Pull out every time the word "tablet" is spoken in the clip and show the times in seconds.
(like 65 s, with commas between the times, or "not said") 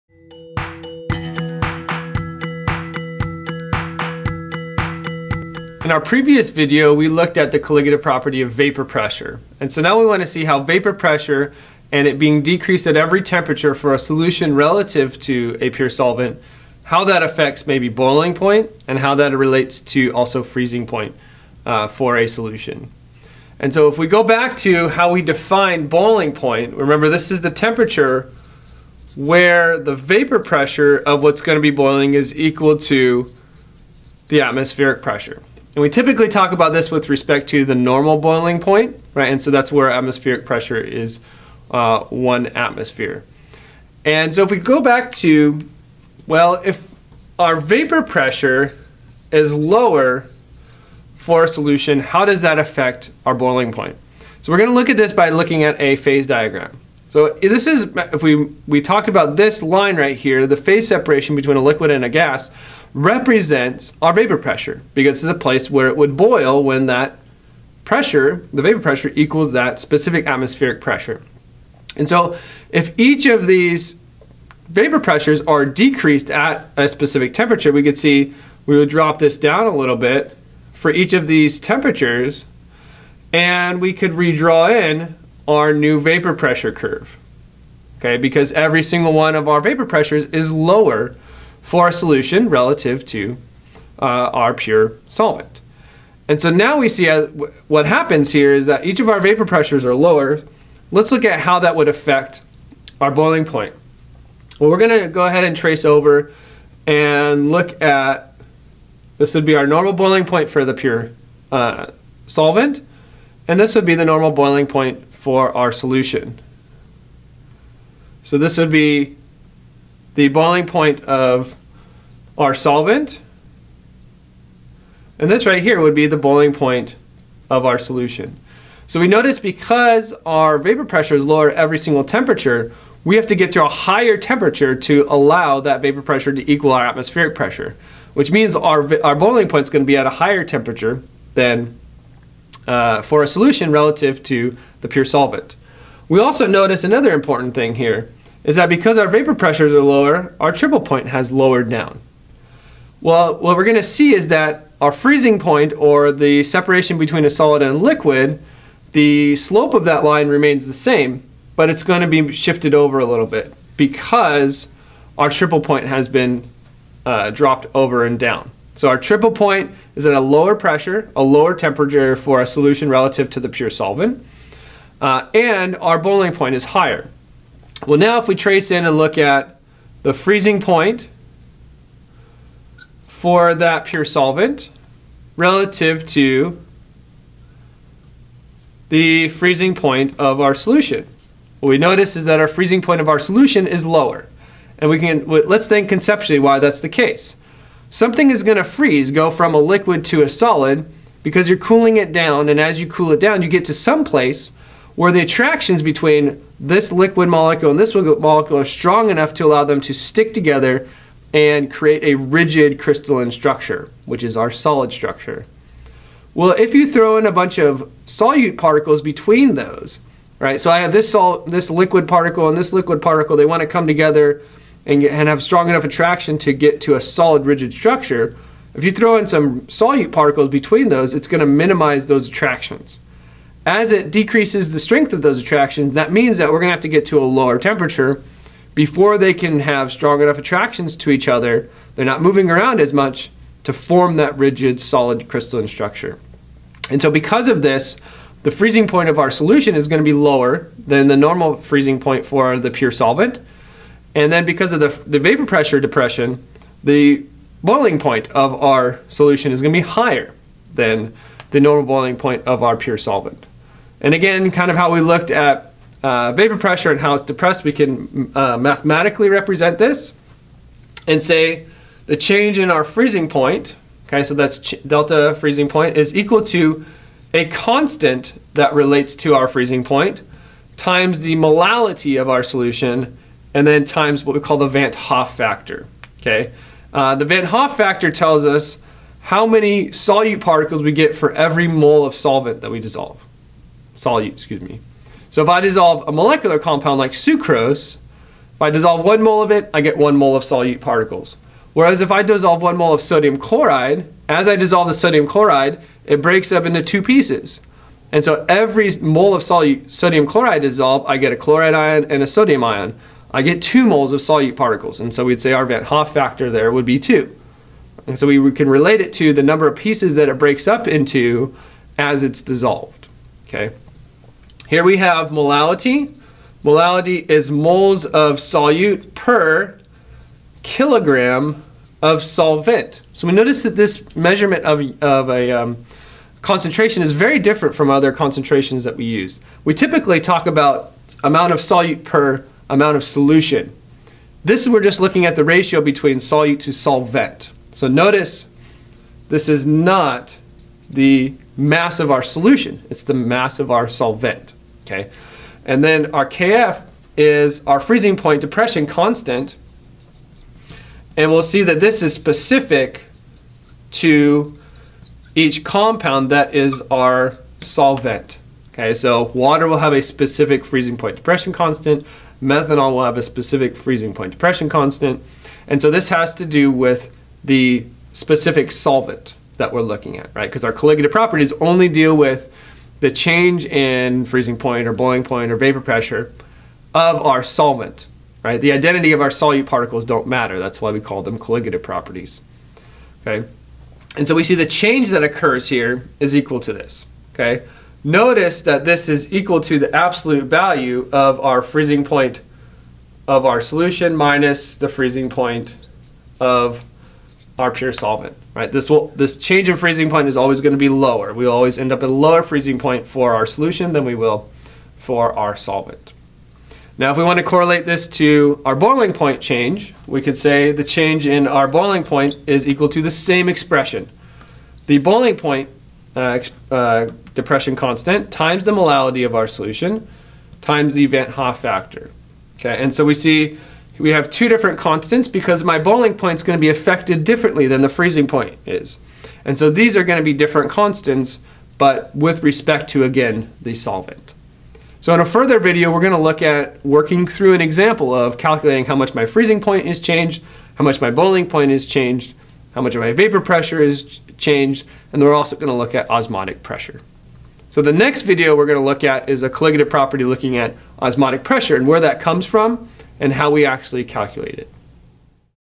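not said.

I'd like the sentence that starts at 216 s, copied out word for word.
Well, if you throw in a bunch of solute particles between those, right?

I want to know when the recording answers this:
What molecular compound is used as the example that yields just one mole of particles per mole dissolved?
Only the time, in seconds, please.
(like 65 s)
297 s.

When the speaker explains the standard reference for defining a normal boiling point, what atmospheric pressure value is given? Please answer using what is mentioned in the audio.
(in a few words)
1 atmosphere.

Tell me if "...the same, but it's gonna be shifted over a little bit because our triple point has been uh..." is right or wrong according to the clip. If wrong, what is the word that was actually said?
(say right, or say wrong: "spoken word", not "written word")
right.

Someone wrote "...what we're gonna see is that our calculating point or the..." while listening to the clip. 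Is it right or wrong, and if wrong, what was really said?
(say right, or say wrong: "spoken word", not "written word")
wrong: "freezing", not "calculating".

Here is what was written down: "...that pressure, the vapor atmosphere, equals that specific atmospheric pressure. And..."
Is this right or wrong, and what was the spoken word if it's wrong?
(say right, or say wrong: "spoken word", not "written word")
wrong: "pressure", not "atmosphere".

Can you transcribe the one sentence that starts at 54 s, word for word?
So we're gonna look at this by looking at a phase diagram.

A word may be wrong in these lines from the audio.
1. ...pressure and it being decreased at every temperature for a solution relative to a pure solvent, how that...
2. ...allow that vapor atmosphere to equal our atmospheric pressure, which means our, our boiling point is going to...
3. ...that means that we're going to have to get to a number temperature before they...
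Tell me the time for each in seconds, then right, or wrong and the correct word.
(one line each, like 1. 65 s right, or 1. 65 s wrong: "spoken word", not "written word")
1. 10 s right
2. 135 s wrong: "pressure", not "atmosphere"
3. 235 s wrong: "lower", not "number".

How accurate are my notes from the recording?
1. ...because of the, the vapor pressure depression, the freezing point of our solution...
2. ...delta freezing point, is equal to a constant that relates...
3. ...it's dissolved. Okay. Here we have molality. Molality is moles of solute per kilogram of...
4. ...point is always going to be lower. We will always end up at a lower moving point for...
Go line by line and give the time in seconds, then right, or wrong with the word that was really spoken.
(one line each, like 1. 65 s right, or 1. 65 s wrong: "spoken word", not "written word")
1. 254 s wrong: "boiling", not "freezing"
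2. 274 s right
3. 322 s right
4. 410 s wrong: "freezing", not "moving".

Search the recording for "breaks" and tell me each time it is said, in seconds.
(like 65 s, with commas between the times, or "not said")
306 s, 320 s.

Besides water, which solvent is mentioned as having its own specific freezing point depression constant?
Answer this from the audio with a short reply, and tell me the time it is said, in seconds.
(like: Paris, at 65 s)
methanol, at 372 s.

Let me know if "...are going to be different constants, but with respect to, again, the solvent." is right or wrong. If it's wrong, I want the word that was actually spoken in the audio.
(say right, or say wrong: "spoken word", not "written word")
right.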